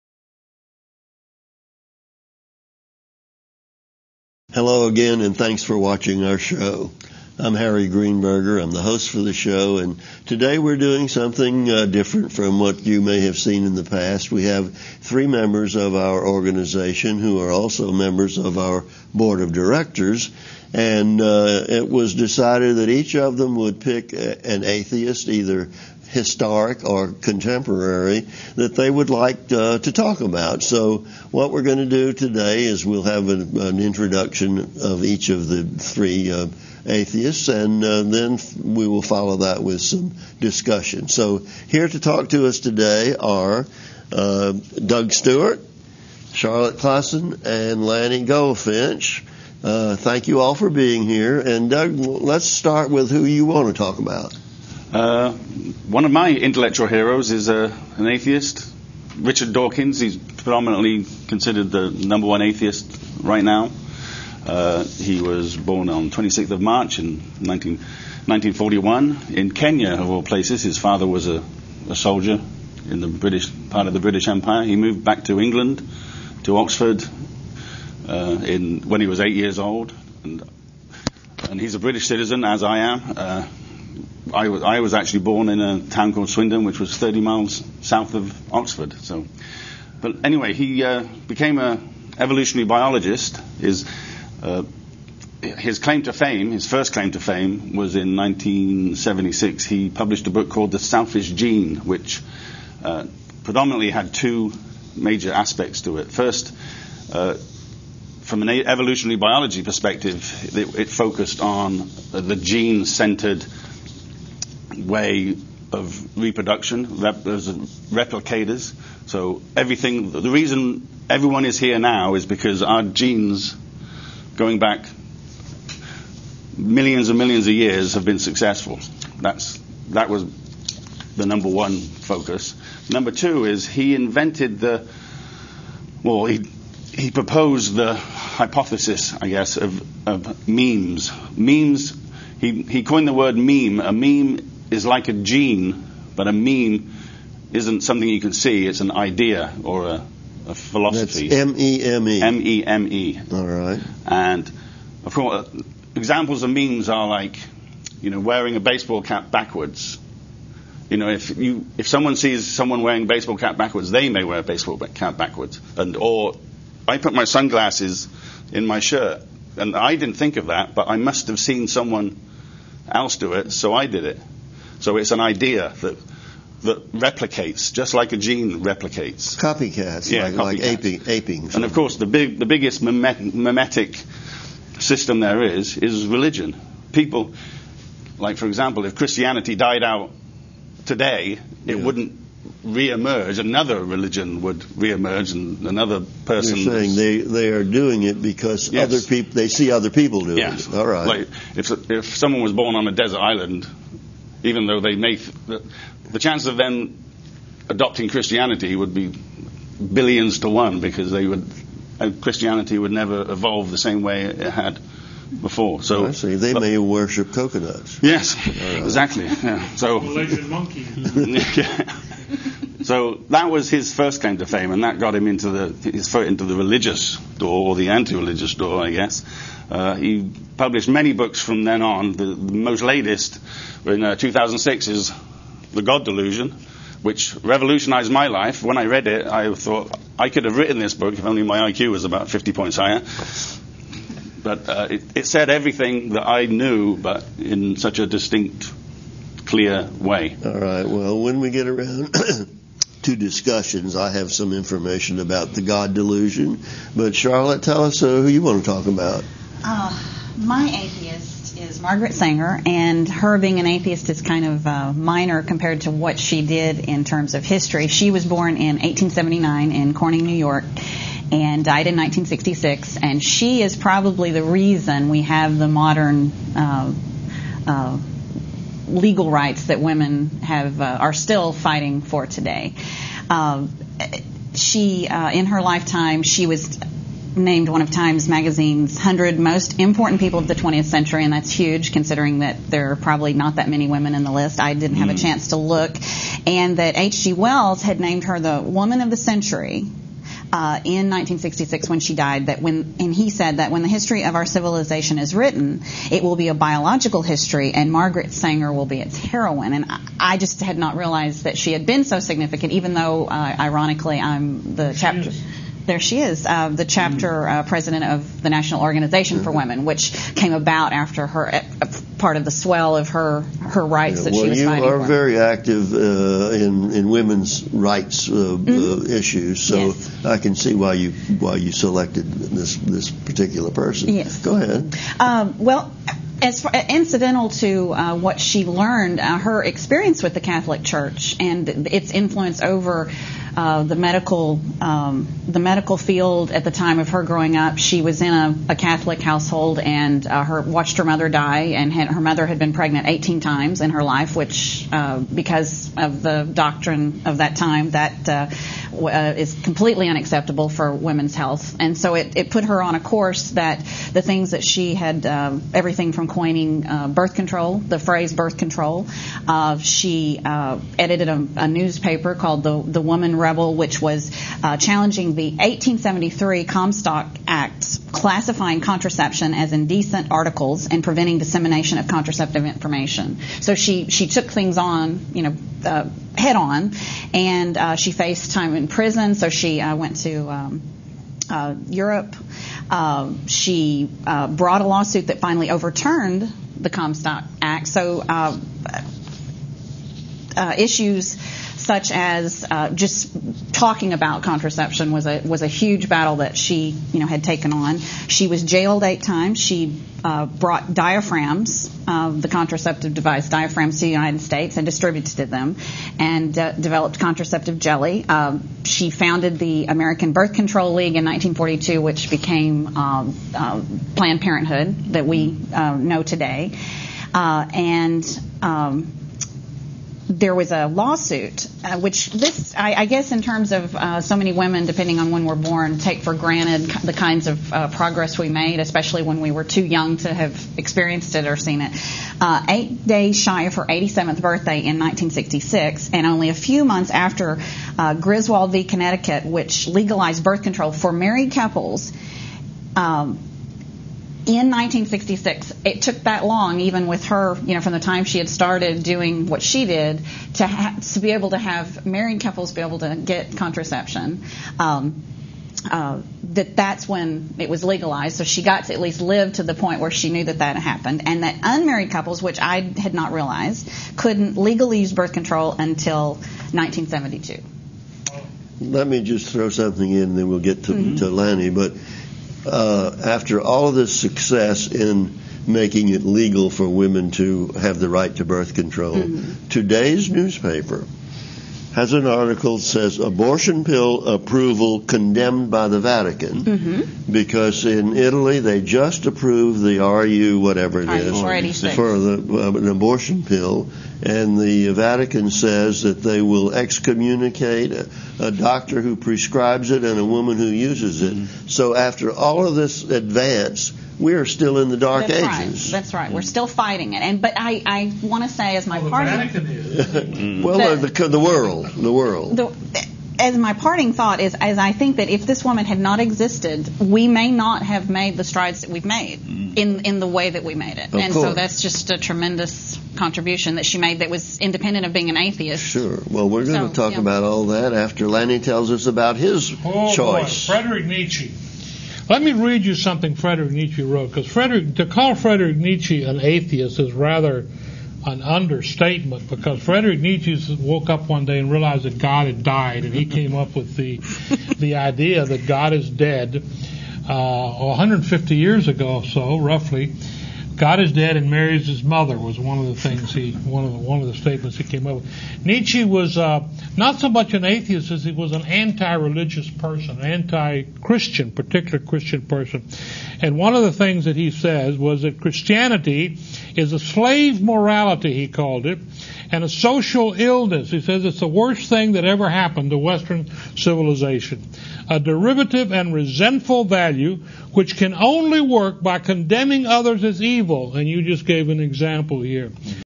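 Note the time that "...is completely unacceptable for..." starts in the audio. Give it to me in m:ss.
5:59.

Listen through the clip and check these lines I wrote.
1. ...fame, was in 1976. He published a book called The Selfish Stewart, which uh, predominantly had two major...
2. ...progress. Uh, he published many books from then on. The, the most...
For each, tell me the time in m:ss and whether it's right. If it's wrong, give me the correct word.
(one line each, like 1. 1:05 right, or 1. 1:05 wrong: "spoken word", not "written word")
1. 1:37 wrong: "Gene", not "Stewart"
2. 3:48 wrong: "guess", not "progress".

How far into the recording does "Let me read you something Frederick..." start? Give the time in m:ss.
9:02.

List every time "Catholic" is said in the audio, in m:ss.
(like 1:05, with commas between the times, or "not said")
5:40, 5:48.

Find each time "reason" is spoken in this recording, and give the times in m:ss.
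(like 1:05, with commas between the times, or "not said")
2:00, 4:34.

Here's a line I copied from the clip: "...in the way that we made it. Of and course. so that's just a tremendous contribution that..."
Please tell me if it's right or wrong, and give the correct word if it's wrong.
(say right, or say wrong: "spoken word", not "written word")
right.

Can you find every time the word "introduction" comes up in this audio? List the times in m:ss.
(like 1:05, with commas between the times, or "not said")
0:33.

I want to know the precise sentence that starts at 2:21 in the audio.
Memes, he, he coined the word meme.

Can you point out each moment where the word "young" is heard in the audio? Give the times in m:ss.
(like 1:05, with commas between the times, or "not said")
7:19.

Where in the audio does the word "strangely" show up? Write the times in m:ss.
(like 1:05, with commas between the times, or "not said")
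not said.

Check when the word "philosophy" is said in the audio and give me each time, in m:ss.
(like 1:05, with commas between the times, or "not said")
2:30.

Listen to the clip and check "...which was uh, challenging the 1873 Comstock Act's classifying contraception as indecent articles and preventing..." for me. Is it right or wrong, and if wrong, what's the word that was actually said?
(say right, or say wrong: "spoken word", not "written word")
right.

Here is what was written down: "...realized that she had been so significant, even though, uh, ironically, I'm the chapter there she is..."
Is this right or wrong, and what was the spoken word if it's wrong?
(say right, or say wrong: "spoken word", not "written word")
right.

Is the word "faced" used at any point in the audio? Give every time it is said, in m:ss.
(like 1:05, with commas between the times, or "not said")
6:28.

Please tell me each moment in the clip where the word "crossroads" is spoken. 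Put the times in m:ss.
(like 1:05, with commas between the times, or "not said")
not said.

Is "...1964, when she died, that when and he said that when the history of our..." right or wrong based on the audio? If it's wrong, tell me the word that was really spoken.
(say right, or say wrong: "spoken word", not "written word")
wrong: "1966", not "1964".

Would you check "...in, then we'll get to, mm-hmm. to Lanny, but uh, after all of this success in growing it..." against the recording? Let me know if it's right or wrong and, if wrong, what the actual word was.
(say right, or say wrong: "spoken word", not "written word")
wrong: "making", not "growing".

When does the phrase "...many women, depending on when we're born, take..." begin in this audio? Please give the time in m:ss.
7:14.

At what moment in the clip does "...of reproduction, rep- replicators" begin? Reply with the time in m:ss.
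1:55.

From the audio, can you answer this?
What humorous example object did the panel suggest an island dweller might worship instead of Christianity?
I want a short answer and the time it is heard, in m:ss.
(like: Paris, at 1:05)
coconuts, at 3:37.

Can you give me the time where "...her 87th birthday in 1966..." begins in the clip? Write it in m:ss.
7:23.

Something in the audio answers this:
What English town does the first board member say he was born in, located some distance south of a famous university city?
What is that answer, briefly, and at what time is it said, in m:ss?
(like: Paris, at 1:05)
Swindon, at 1:26.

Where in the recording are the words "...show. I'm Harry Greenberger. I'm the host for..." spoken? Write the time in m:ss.
0:06.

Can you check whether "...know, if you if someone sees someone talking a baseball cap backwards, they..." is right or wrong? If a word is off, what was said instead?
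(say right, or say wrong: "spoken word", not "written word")
wrong: "wearing", not "talking".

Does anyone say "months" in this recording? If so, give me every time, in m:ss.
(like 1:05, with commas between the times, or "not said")
7:26.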